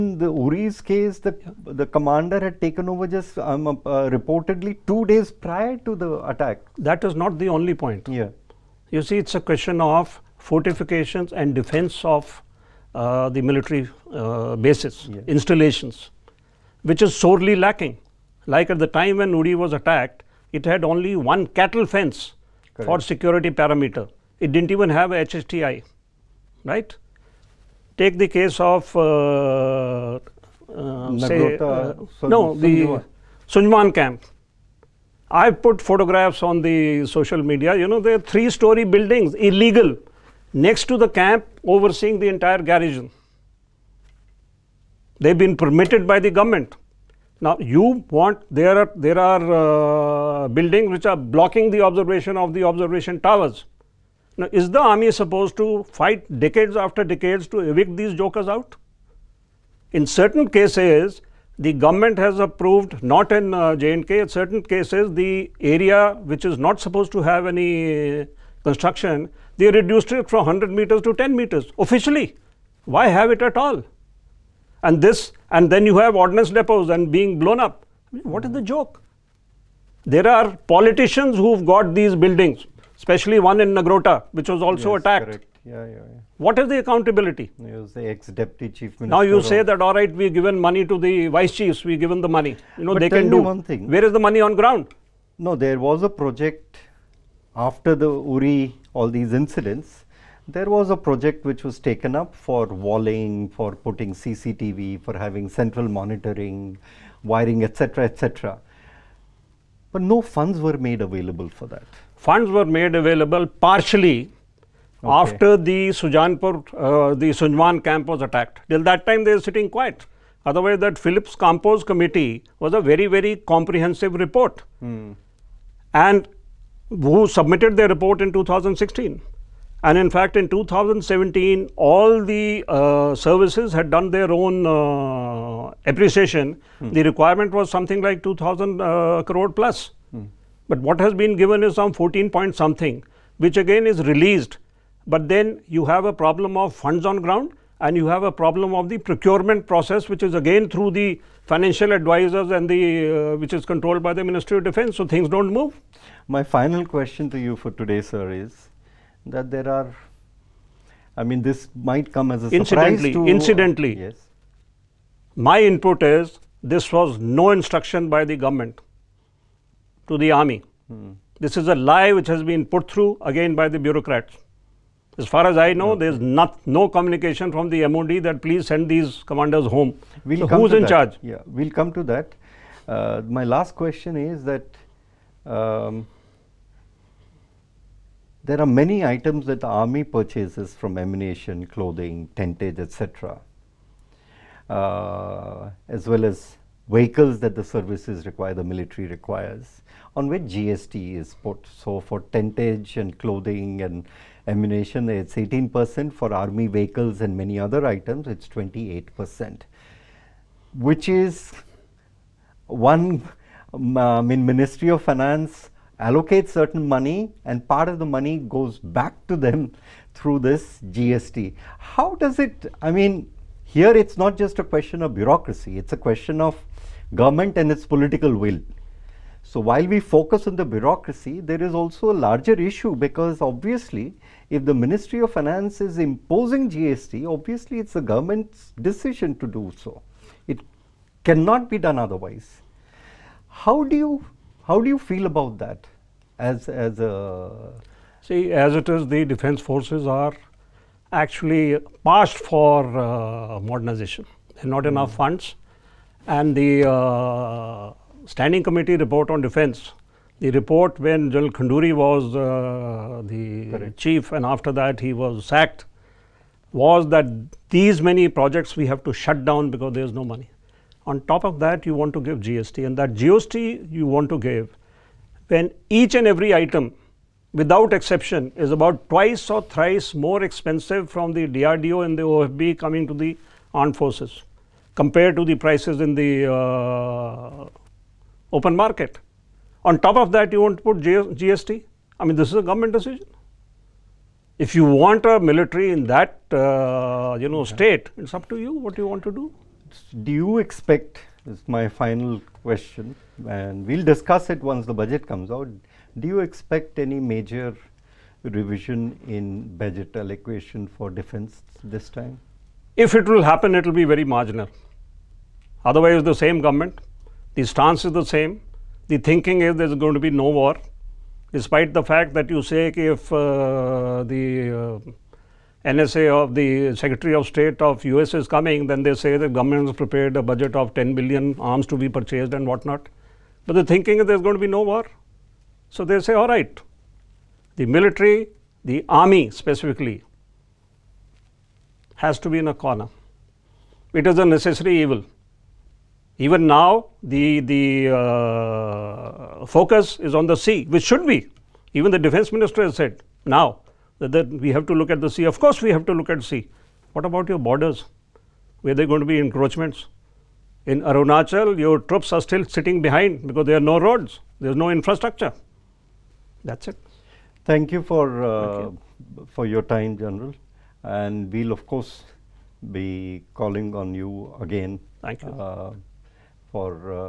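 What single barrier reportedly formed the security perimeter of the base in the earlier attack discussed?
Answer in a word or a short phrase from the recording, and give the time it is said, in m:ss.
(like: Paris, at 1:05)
cattle fence, at 0:21.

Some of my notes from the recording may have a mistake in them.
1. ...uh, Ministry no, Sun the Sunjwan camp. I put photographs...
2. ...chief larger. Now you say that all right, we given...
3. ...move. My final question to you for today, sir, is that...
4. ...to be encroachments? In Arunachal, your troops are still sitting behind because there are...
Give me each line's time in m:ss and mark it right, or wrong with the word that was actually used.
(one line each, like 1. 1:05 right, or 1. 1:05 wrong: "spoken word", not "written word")
1. 0:31 wrong: "Sun", not "Ministry"
2. 1:28 wrong: "minister", not "larger"
3. 2:35 right
4. 5:59 right.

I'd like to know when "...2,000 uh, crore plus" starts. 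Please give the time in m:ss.
2:18.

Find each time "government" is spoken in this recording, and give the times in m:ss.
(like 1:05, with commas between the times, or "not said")
0:46, 1:01, 2:48, 3:47, 3:58, 4:52, 5:16, 5:29.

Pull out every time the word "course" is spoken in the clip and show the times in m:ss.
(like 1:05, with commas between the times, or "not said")
5:55, 6:11.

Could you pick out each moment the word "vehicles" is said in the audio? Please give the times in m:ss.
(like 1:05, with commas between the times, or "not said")
3:16, 3:26.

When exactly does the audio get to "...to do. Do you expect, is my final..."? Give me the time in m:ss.
4:59.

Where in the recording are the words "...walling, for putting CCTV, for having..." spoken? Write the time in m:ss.
1:42.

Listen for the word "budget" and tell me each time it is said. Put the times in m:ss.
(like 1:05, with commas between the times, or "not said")
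5:05, 5:09, 5:30.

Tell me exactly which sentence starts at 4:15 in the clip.
funds and the uh, standing committee report on defense.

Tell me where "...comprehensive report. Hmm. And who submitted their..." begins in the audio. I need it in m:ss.
2:03.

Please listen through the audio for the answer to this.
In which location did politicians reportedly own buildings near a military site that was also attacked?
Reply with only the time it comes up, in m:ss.
1:23.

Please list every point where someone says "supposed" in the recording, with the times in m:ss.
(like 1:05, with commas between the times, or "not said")
0:55, 1:06.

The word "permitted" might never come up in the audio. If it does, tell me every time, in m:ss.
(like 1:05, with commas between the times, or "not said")
0:45.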